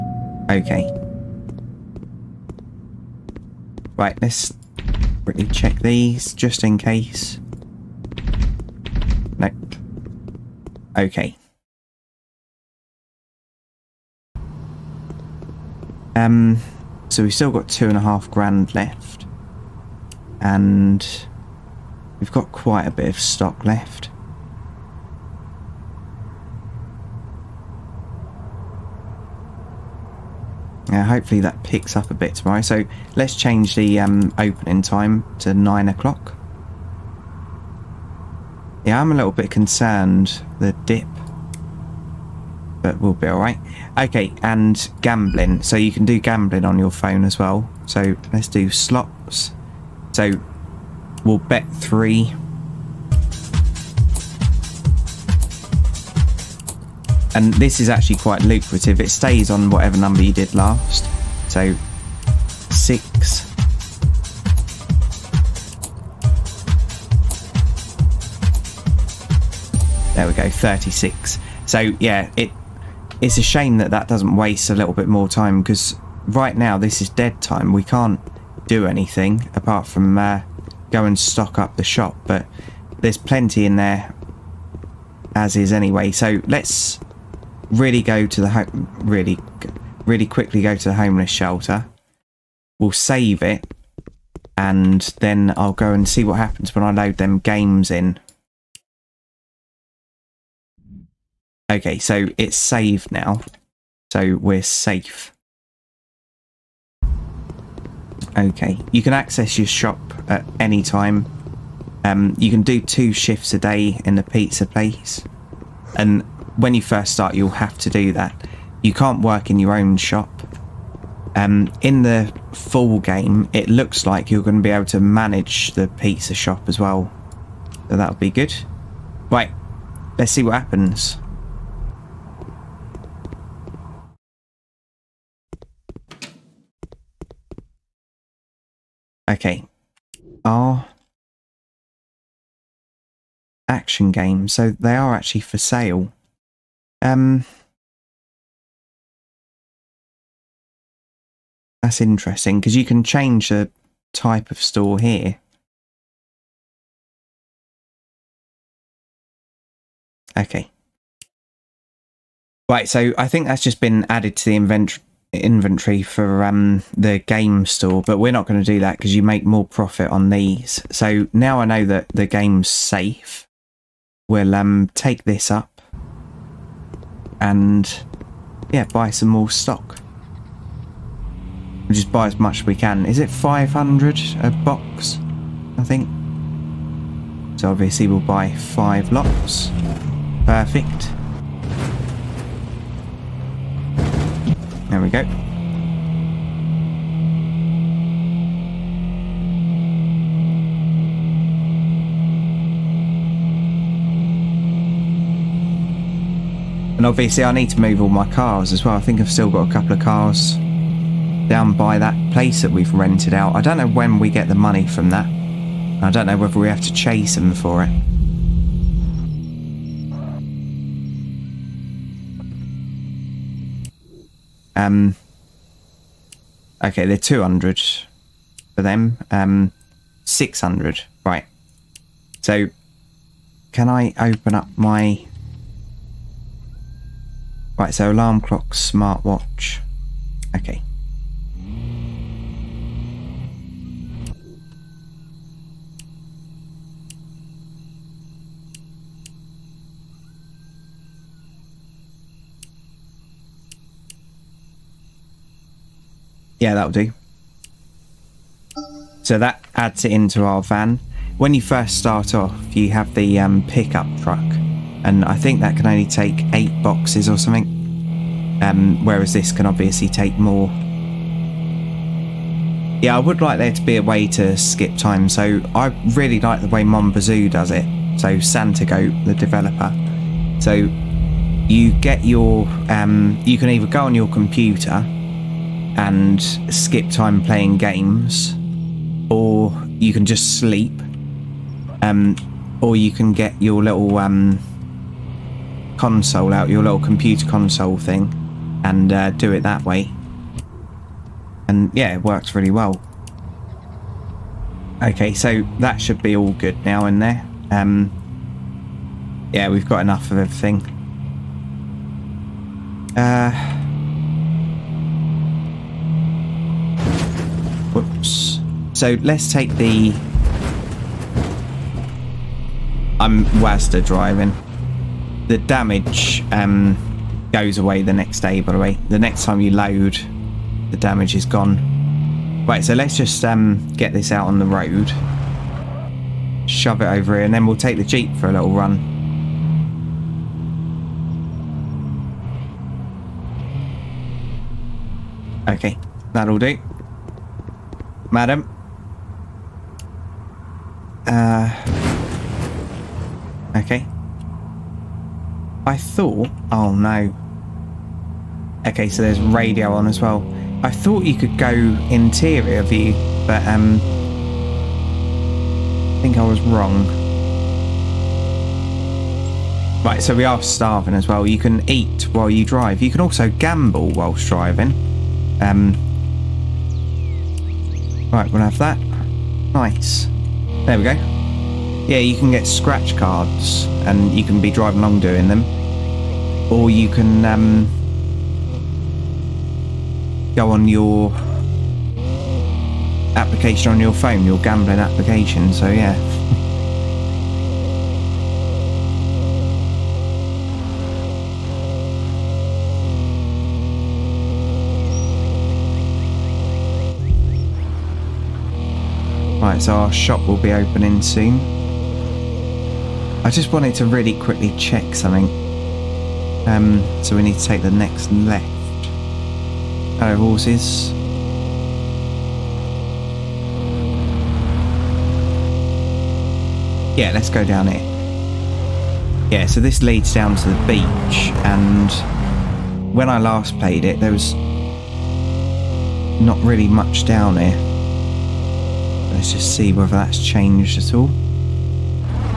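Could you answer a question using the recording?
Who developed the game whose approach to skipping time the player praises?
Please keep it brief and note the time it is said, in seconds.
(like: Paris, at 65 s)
Santa Goat, at 278 s.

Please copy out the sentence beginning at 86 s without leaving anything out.
So let's really go to the really really quickly go to the homeless shelter.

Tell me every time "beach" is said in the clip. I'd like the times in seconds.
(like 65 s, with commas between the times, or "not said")
430 s.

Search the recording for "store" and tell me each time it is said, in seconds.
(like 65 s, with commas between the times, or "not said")
154 s, 167 s.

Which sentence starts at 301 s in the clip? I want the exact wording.
And yeah, it works really well.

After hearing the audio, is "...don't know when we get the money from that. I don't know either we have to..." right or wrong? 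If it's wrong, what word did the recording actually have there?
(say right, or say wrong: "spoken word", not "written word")
wrong: "whether", not "either".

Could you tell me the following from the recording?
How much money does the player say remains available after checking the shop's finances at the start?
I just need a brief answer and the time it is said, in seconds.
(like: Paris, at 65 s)
two and a half grand, at 17 s.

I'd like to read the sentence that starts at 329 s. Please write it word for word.
The next time you load, the damage is gone.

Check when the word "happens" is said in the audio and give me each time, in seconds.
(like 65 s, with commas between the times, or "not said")
96 s, 130 s.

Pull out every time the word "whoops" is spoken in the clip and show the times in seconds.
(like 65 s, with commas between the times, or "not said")
317 s.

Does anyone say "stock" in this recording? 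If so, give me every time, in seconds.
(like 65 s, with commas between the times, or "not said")
23 s, 81 s, 179 s.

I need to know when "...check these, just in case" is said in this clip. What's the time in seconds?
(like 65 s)
5 s.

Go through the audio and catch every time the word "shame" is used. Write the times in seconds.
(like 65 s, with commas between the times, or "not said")
73 s.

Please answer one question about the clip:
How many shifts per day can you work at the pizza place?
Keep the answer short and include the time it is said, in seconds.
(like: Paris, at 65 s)
2, at 112 s.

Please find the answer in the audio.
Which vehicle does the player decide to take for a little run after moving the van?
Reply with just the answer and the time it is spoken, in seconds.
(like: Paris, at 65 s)
the Jeep, at 337 s.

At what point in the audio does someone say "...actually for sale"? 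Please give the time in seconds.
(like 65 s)
145 s.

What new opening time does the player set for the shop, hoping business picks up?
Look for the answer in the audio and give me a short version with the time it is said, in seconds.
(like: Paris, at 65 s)
9 o'clock, at 35 s.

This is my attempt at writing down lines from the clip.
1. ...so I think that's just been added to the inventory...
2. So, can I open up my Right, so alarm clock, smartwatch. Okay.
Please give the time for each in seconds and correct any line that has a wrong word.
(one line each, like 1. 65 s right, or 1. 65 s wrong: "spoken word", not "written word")
1. 162 s right
2. 232 s right.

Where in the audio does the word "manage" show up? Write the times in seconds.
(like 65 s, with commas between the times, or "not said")
124 s.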